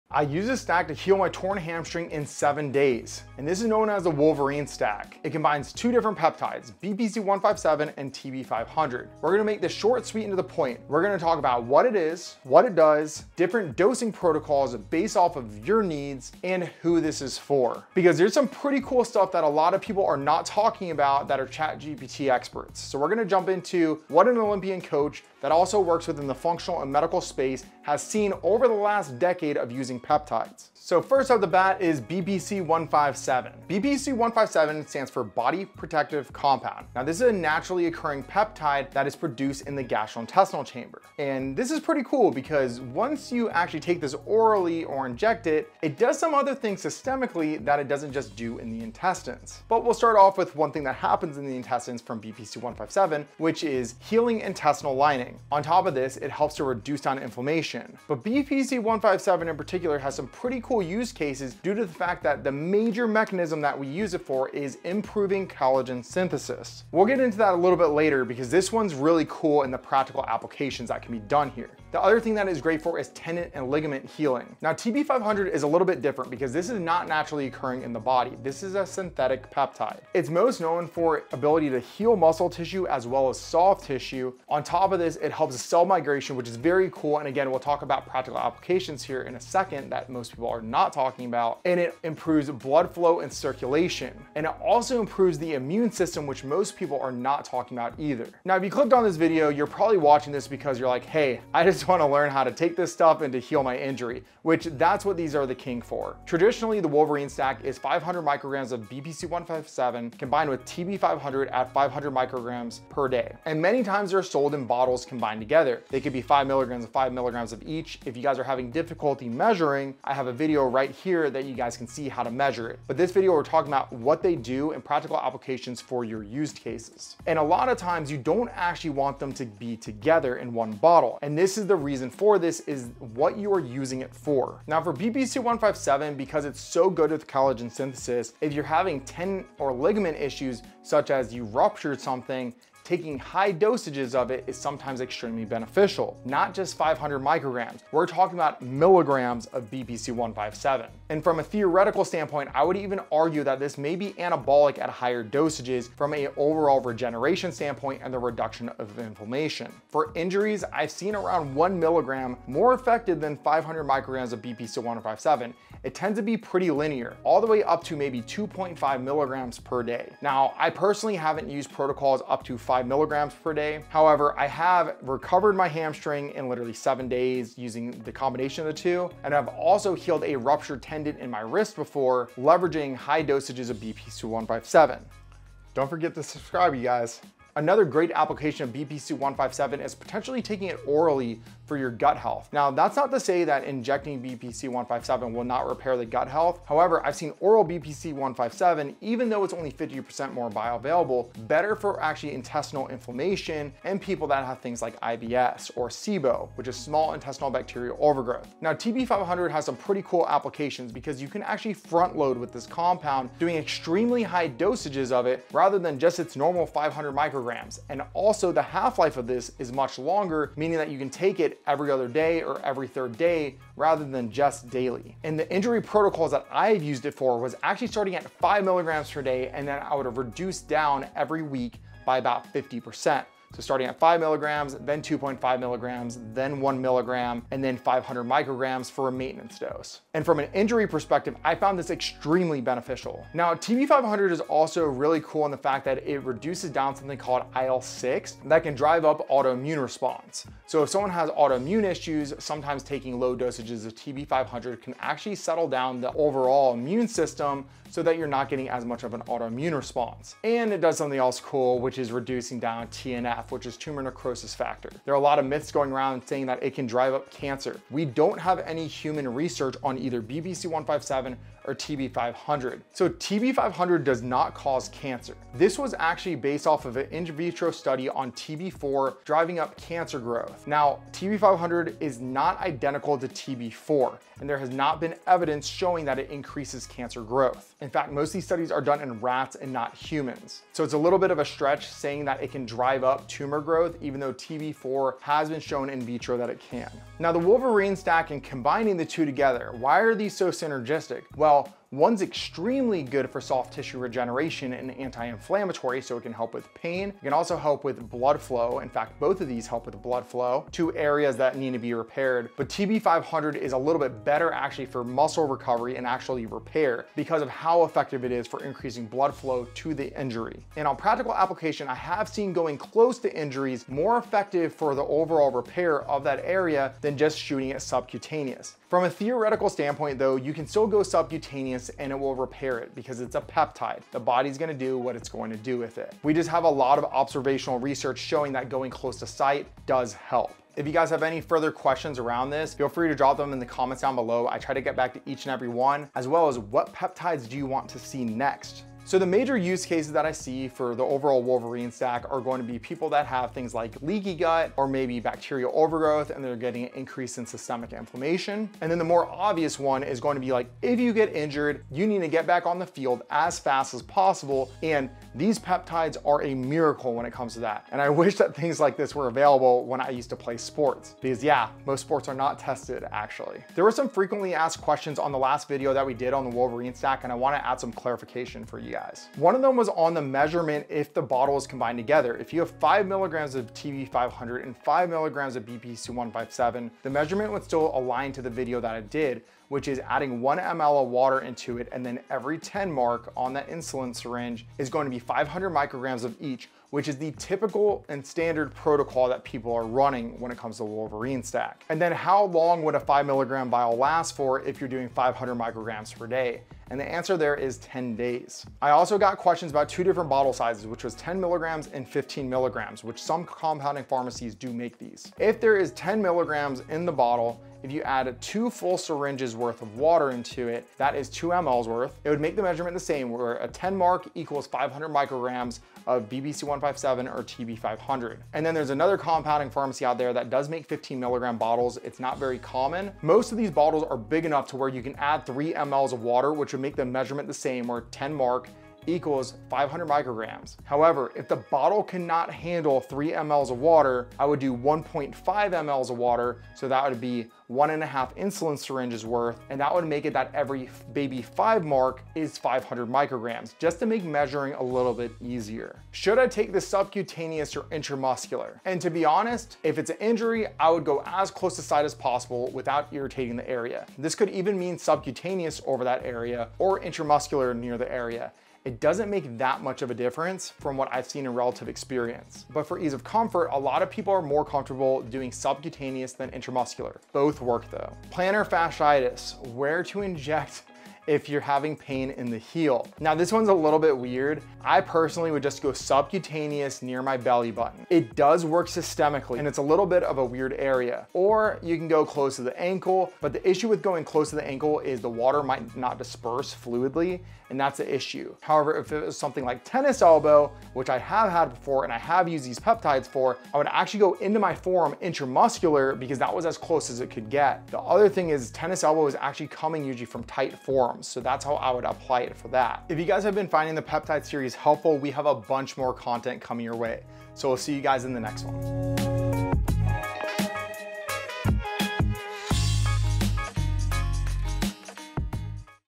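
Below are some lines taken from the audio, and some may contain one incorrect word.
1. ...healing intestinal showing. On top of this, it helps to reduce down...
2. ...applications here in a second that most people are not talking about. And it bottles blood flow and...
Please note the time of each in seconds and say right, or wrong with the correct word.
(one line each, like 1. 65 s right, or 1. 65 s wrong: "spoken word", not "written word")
1. 54 s wrong: "lining", not "showing"
2. 88 s wrong: "improves", not "bottles".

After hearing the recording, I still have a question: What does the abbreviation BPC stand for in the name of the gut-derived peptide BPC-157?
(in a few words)
Body Protective Compound.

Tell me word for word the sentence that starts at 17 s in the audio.
Because there's some pretty cool stuff that a lot of people are not talking about that are ChatGPT experts.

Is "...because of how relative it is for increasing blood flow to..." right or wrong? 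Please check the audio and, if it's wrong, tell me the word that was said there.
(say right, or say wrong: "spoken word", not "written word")
wrong: "effective", not "relative".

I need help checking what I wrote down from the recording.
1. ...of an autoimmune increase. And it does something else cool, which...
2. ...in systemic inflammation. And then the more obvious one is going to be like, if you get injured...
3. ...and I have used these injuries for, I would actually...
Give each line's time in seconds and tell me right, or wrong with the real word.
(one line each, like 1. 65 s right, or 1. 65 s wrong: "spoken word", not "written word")
1. 259 s wrong: "response", not "increase"
2. 357 s right
3. 502 s wrong: "peptides", not "injuries".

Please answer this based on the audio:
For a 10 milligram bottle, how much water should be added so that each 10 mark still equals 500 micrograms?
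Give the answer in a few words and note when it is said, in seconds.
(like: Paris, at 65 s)
2 mLs, at 421 s.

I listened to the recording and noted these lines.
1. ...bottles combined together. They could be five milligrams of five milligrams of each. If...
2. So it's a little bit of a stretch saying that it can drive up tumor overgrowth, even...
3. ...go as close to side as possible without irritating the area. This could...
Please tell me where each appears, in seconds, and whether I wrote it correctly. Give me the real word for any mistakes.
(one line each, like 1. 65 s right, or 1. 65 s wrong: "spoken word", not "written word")
1. 114 s right
2. 290 s wrong: "growth", not "overgrowth"
3. 461 s right.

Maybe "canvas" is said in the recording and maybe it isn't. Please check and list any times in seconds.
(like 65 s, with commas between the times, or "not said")
not said.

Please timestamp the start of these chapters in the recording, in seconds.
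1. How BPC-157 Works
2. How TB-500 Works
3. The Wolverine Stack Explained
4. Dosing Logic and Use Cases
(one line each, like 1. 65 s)
1. 32 s
2. 76 s
3. 106 s
4. 348 s.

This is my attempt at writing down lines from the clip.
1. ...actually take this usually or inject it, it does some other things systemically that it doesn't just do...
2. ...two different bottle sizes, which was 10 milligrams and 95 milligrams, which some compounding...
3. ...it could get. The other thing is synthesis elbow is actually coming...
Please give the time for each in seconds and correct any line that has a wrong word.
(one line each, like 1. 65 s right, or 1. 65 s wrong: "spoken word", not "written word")
1. 43 s wrong: "orally", not "usually"
2. 409 s wrong: "15", not "95"
3. 507 s wrong: "tennis", not "synthesis".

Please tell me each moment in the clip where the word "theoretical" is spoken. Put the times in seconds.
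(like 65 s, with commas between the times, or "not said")
151 s, 329 s.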